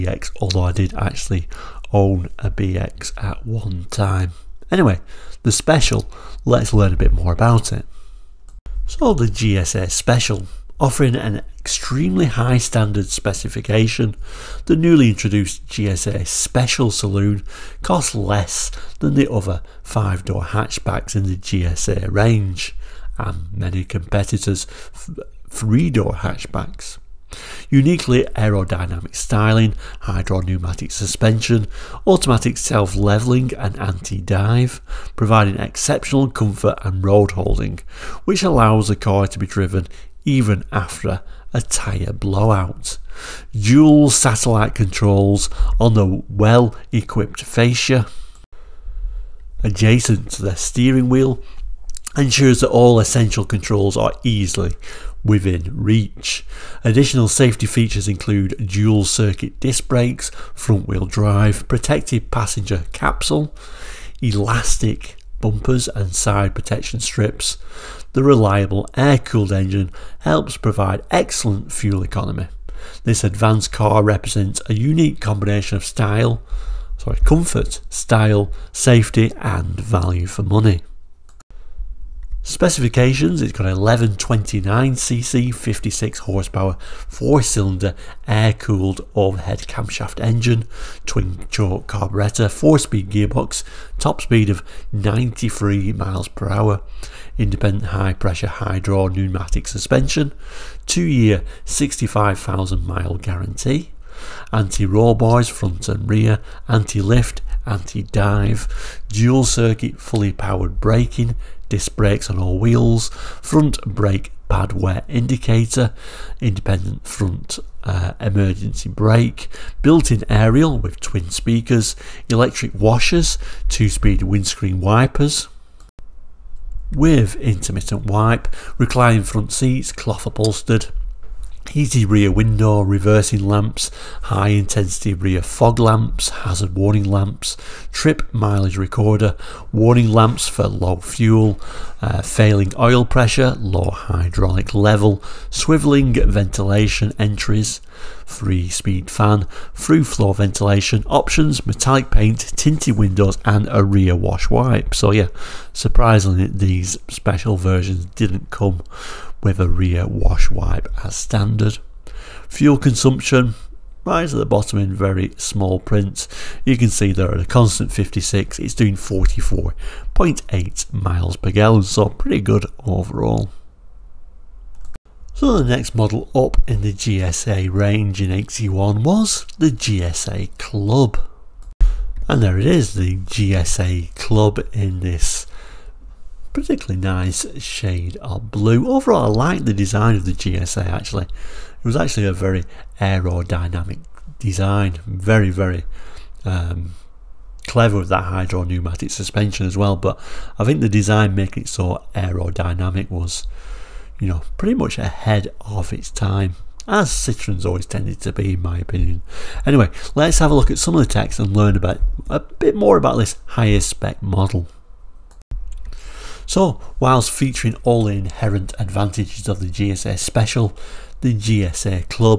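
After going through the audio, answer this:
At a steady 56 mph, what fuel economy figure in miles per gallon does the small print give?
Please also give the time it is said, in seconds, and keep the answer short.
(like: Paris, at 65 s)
44.8, at 168 s.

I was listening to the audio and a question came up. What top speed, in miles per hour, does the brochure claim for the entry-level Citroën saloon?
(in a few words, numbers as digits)
93.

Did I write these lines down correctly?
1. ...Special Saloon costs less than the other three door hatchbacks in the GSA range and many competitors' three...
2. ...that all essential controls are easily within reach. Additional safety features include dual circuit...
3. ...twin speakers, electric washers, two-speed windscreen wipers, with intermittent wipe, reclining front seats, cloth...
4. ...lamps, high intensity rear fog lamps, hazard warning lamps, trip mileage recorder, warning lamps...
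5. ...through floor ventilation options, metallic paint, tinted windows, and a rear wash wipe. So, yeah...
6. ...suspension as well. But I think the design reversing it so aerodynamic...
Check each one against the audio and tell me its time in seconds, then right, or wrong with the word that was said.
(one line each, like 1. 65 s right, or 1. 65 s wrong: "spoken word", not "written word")
1. 16 s wrong: "five", not "three"
2. 52 s right
3. 121 s right
4. 133 s right
5. 149 s right
6. 199 s wrong: "making", not "reversing".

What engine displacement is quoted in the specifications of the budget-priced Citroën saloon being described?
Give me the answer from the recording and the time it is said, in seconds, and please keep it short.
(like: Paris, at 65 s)
1129cc, at 83 s.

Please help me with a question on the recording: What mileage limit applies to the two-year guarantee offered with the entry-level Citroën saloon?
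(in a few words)
65,000 miles.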